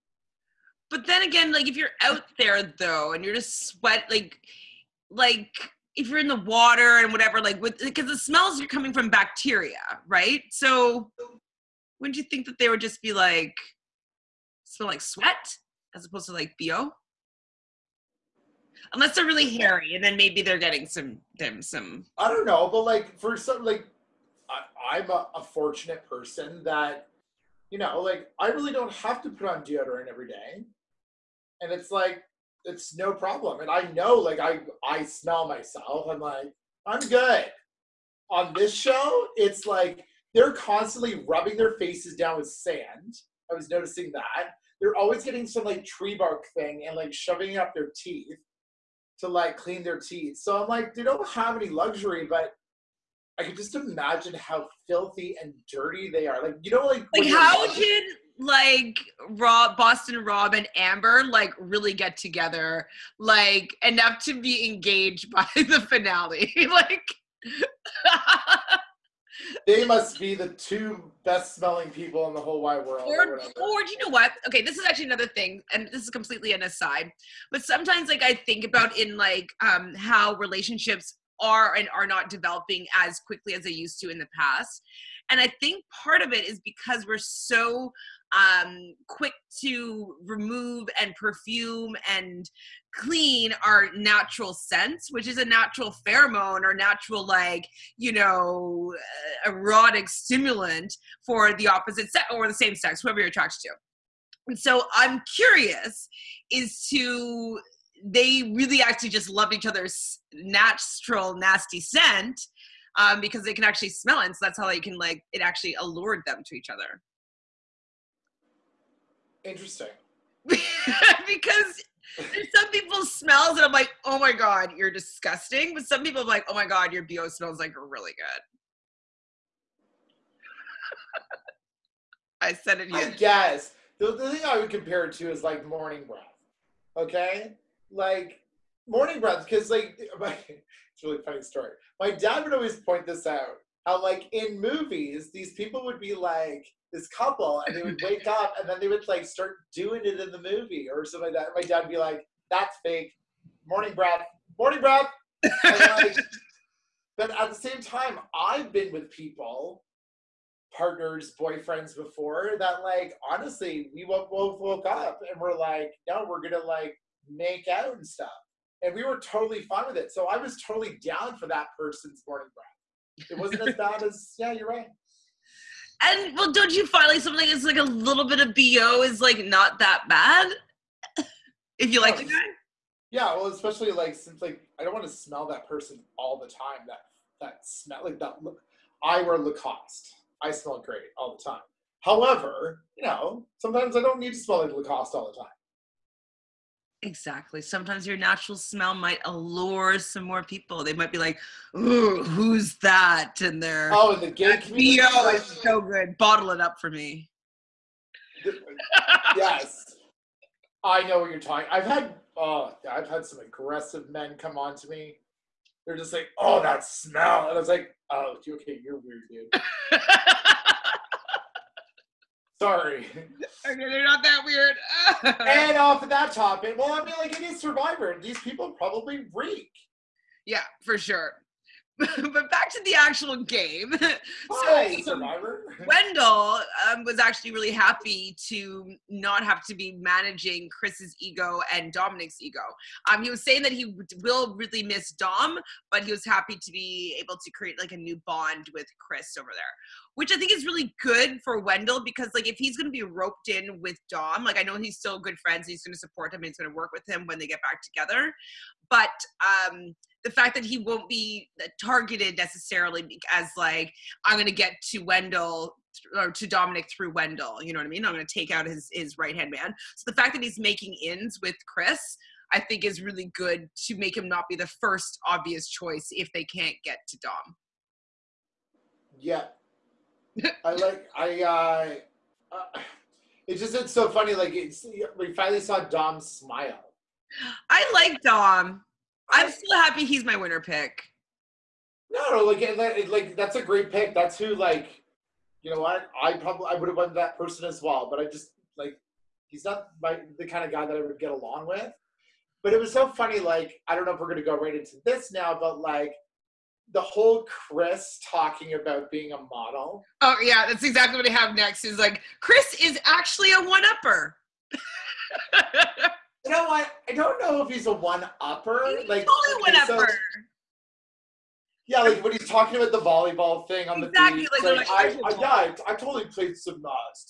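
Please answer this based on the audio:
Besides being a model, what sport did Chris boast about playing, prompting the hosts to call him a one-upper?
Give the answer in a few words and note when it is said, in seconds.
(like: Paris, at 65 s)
volleyball, at 322 s.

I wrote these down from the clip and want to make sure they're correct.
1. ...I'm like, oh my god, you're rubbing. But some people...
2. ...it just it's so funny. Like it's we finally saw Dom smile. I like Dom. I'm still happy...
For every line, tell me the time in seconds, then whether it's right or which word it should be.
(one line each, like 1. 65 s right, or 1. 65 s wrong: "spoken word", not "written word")
1. 123 s wrong: "disgusting", not "rubbing"
2. 283 s right.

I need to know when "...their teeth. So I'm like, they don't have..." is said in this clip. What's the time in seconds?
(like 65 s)
49 s.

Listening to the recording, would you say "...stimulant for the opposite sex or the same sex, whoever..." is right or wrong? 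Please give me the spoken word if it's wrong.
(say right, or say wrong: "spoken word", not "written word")
right.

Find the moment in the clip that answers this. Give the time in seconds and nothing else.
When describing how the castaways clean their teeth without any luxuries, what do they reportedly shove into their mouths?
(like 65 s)
45 s.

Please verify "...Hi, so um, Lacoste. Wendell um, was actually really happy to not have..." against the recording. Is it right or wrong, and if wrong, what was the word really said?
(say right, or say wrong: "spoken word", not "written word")
wrong: "Survivor", not "Lacoste".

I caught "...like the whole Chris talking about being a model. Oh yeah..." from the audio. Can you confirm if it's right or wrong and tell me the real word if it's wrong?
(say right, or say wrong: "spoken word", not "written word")
right.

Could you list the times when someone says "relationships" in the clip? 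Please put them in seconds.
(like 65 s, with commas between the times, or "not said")
80 s.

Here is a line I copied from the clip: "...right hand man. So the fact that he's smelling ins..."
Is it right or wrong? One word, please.
wrong.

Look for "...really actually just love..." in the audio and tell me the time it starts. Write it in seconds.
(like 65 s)
108 s.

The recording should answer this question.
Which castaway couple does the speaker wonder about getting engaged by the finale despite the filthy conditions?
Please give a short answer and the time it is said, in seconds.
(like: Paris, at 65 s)
Boston Rob and Amber, at 59 s.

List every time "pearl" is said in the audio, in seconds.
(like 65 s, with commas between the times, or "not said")
not said.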